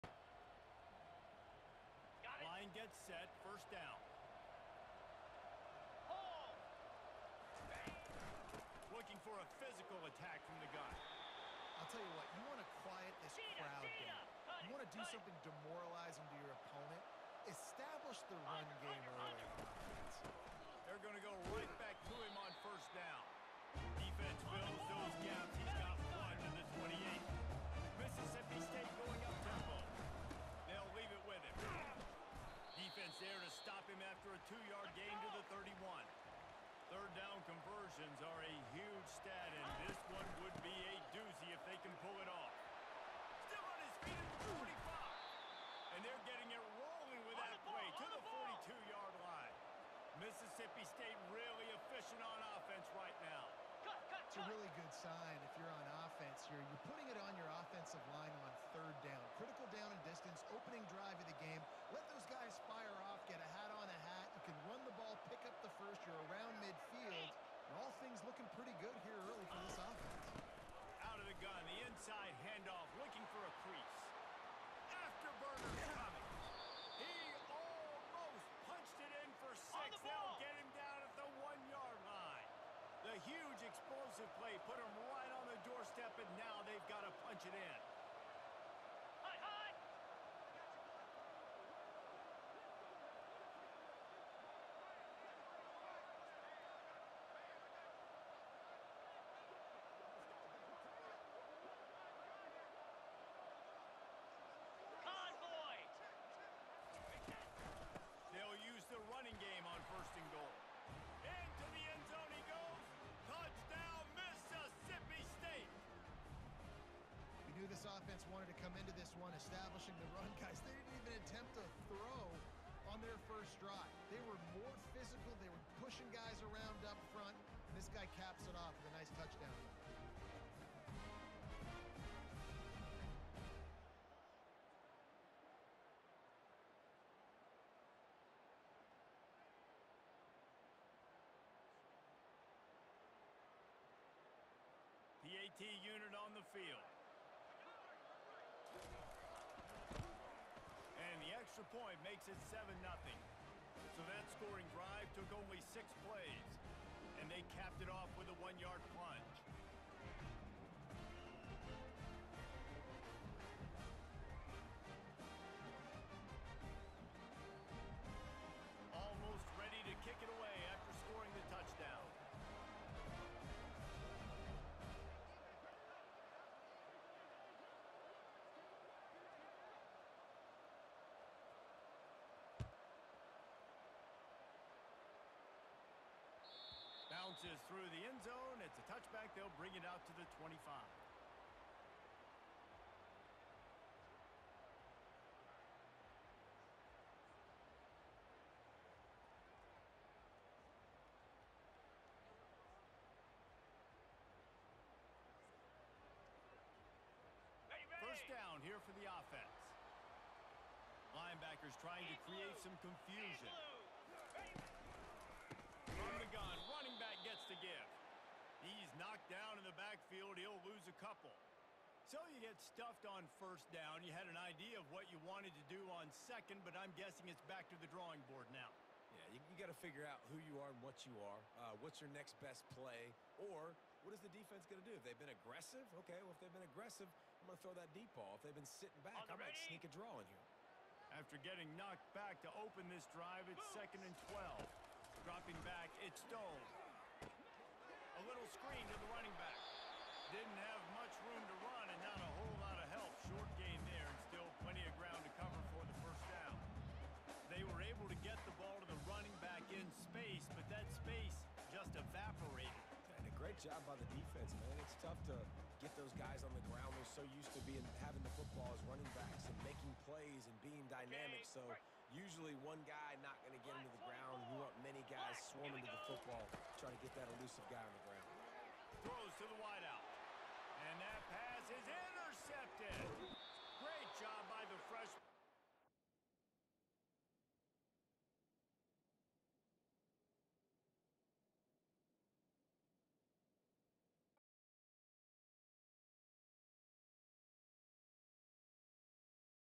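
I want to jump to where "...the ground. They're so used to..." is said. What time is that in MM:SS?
04:26.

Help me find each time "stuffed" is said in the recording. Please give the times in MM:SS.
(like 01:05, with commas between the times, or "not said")
03:42.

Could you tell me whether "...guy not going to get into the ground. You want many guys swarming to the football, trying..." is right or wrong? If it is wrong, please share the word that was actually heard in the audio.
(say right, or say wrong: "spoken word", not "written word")
right.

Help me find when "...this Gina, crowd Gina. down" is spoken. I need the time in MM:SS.
00:13.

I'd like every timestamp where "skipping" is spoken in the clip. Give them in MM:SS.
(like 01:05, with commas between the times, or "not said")
not said.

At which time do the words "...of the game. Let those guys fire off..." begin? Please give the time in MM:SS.
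01:01.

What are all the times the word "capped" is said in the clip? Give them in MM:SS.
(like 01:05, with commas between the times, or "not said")
02:37.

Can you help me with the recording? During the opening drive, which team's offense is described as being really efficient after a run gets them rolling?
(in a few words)
Mississippi State.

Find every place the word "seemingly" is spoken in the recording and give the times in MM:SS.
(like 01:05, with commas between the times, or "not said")
not said.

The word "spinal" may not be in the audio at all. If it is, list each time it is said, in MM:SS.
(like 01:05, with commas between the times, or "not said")
not said.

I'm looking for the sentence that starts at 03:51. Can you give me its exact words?
Uh, what's your next best play?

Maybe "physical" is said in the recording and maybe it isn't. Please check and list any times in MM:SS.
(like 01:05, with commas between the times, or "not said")
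00:09, 02:04.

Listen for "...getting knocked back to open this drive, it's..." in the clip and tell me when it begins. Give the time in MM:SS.
04:01.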